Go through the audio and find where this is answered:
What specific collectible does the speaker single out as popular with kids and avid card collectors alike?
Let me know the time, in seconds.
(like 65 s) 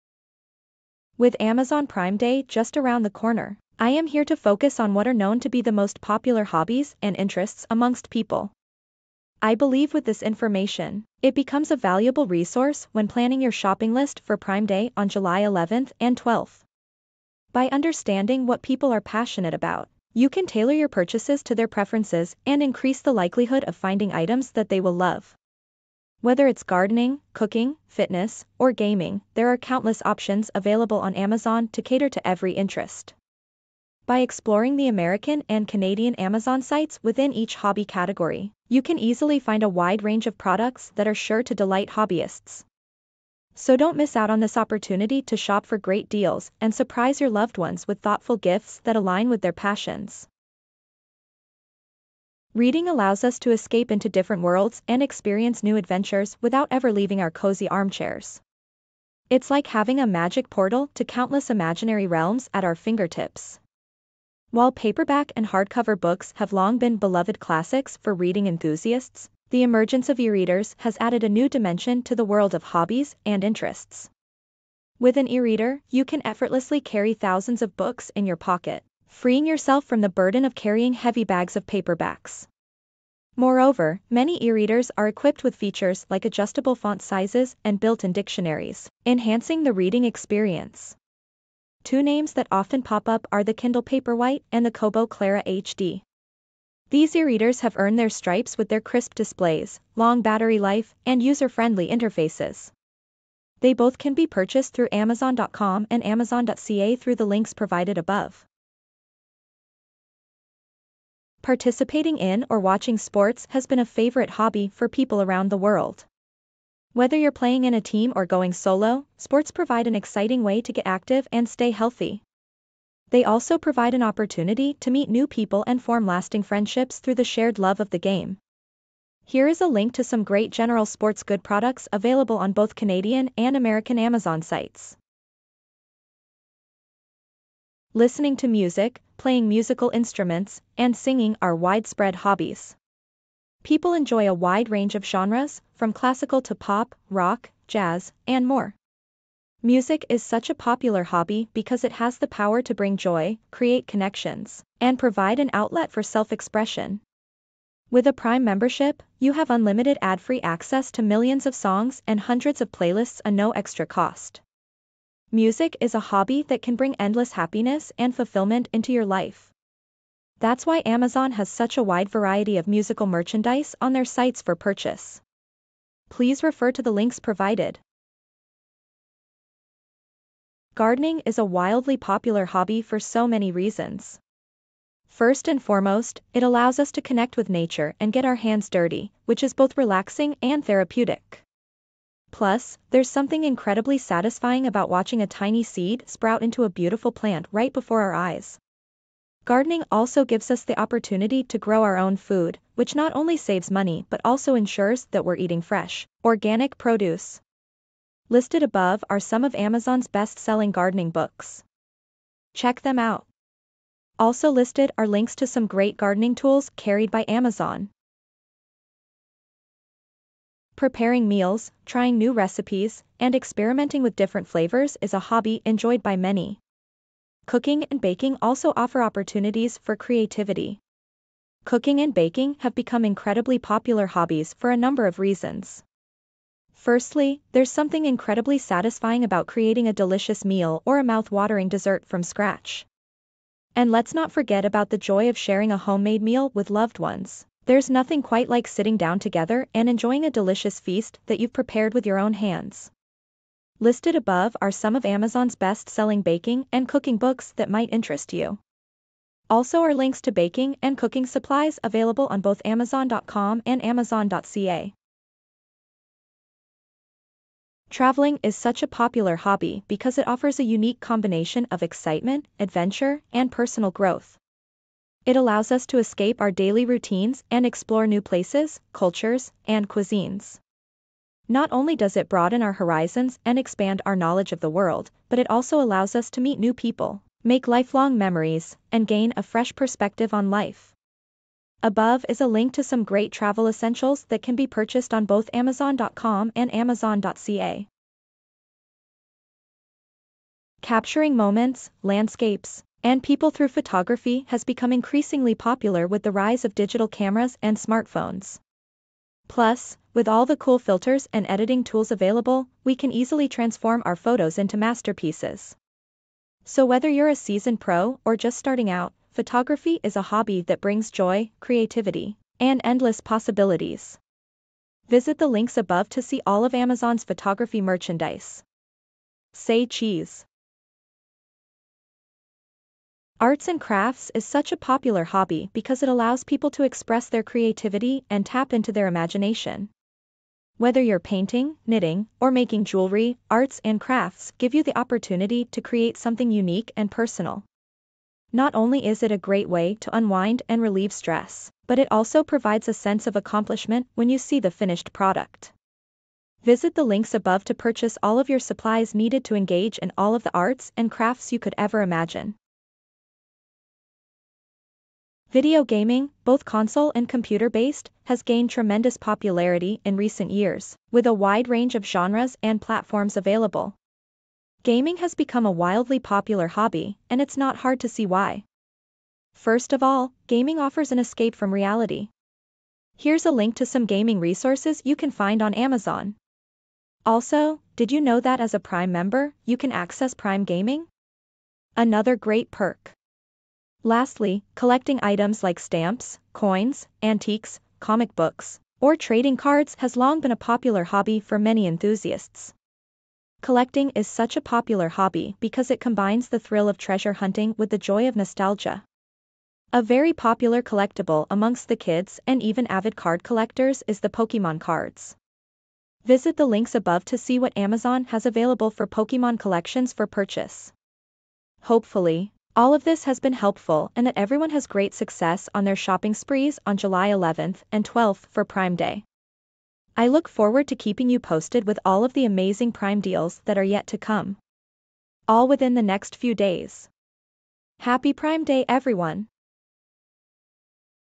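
414 s.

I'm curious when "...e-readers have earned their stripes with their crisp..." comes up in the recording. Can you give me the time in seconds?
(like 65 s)
97 s.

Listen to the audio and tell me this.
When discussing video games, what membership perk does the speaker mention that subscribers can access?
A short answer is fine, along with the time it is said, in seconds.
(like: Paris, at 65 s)
Prime Gaming, at 390 s.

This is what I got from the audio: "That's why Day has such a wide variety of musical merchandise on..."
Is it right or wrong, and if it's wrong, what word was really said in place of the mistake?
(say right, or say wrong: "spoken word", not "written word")
wrong: "Amazon", not "Day".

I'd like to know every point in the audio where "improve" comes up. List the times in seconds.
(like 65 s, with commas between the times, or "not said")
not said.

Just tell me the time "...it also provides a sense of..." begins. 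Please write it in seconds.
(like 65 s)
351 s.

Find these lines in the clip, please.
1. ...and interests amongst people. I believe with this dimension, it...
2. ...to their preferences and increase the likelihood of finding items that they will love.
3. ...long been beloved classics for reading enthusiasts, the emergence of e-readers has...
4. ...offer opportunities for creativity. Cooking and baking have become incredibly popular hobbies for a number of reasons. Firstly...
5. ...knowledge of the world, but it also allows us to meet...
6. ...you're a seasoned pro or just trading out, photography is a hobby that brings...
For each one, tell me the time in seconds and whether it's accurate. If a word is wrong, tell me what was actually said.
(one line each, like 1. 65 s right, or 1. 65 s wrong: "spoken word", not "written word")
1. 6 s wrong: "information", not "dimension"
2. 21 s right
3. 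66 s right
4. 228 s right
5. 284 s right
6. 317 s wrong: "starting", not "trading".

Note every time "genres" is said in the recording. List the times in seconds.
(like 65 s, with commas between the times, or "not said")
145 s, 372 s.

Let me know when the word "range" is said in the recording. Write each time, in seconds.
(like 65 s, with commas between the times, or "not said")
40 s, 144 s, 371 s.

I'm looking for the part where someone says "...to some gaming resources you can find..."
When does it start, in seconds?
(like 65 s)
383 s.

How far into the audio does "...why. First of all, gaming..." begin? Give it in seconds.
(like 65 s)
378 s.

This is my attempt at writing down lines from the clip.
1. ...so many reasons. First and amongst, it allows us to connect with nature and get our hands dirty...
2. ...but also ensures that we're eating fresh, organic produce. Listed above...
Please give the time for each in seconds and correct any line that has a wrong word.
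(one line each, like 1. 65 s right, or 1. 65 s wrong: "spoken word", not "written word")
1. 182 s wrong: "foremost", not "amongst"
2. 204 s right.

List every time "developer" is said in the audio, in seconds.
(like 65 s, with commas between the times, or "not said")
not said.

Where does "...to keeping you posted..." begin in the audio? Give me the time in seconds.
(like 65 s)
430 s.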